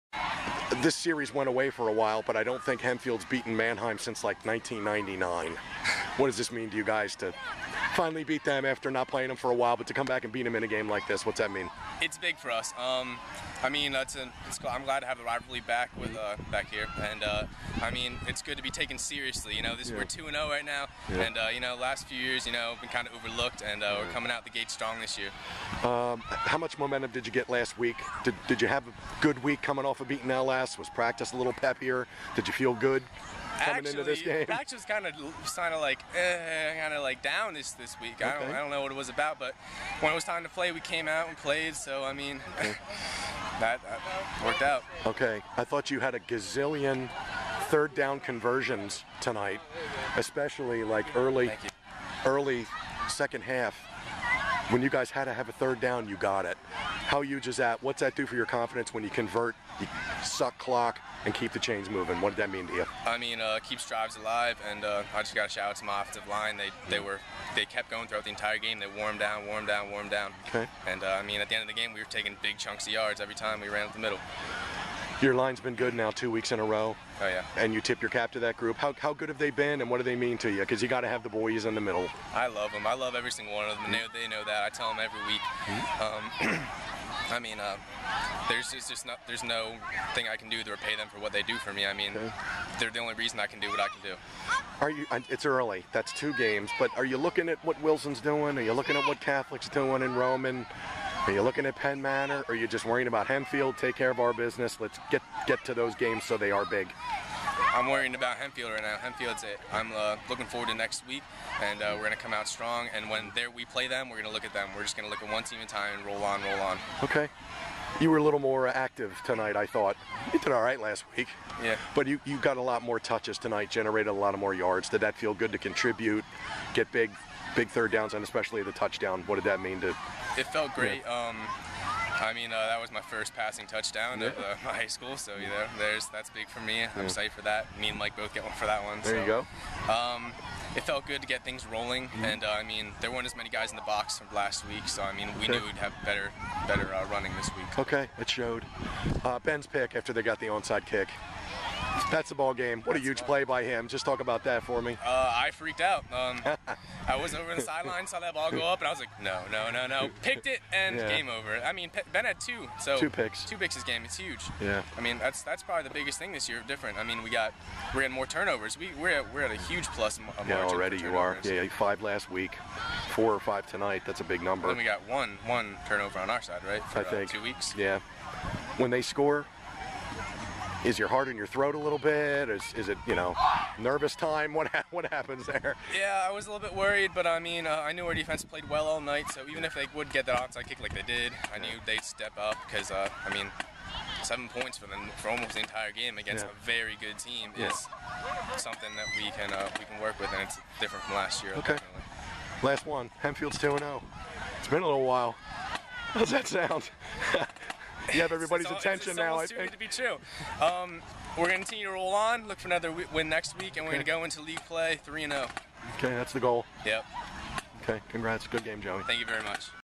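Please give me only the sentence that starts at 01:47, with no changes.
I'm worrying about Hempfield right now.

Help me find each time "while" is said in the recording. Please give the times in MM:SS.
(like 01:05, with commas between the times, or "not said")
00:01, 00:09, 03:25.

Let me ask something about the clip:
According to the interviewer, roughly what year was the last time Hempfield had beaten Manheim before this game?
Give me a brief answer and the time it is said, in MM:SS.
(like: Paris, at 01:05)
1999, at 00:04.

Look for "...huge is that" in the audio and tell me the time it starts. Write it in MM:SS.
00:57.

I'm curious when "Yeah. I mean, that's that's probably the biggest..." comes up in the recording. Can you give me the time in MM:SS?
02:44.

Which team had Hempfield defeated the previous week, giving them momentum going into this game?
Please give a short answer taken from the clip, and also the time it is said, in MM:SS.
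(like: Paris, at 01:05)
LS, at 00:30.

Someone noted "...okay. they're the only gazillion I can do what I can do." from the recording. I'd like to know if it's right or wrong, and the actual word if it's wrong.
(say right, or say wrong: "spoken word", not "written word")
wrong: "reason", not "gazillion".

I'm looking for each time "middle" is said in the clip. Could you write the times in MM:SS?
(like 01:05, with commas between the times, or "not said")
01:13, 01:21.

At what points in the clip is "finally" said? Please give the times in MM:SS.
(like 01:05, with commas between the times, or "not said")
00:07.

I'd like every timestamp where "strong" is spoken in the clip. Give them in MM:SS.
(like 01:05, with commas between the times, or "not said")
00:24, 01:52.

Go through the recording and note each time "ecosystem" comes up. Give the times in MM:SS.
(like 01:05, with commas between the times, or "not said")
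not said.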